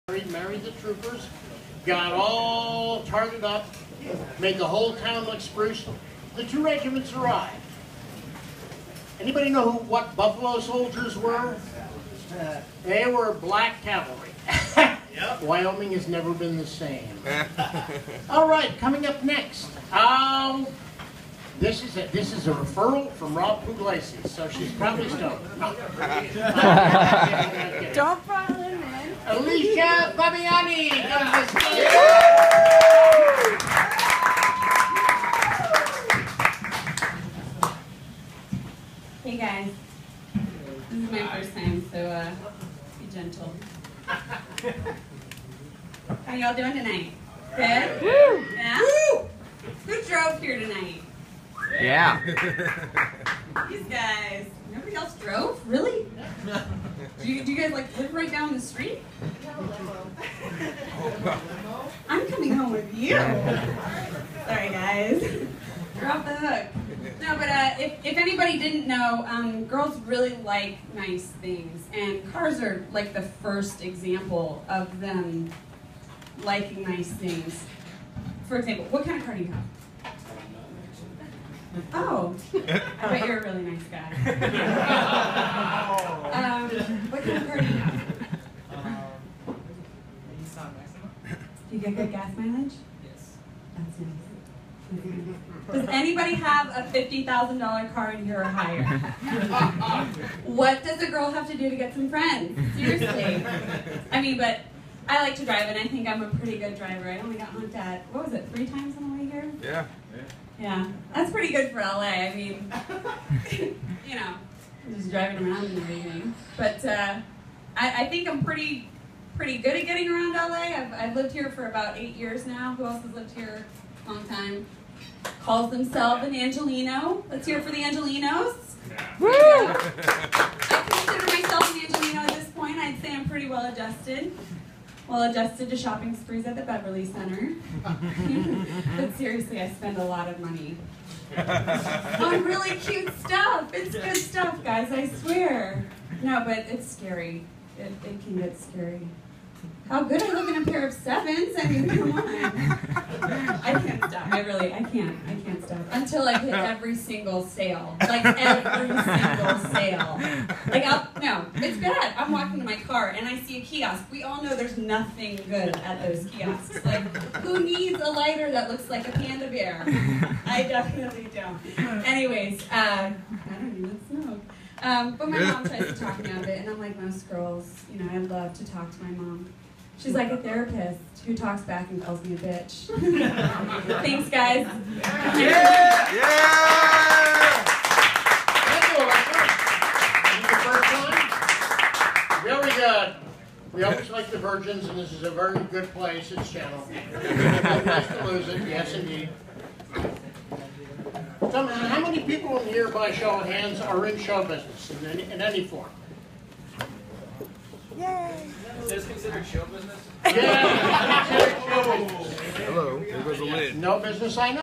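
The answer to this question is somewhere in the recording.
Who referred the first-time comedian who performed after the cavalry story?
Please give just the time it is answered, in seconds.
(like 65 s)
23 s.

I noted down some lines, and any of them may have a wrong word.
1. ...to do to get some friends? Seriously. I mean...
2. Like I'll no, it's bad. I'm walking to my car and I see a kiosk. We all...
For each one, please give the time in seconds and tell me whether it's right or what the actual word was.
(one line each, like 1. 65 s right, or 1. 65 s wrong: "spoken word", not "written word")
1. 101 s right
2. 160 s right.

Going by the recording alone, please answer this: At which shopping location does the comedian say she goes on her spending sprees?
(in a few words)
Beverly Center.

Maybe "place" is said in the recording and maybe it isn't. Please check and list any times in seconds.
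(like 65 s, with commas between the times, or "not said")
195 s.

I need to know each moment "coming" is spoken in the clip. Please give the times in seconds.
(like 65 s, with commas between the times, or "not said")
18 s, 62 s.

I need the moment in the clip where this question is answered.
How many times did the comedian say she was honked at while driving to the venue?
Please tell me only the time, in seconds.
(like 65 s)
108 s.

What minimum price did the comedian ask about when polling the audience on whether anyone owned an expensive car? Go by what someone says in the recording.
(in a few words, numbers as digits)
$50,000.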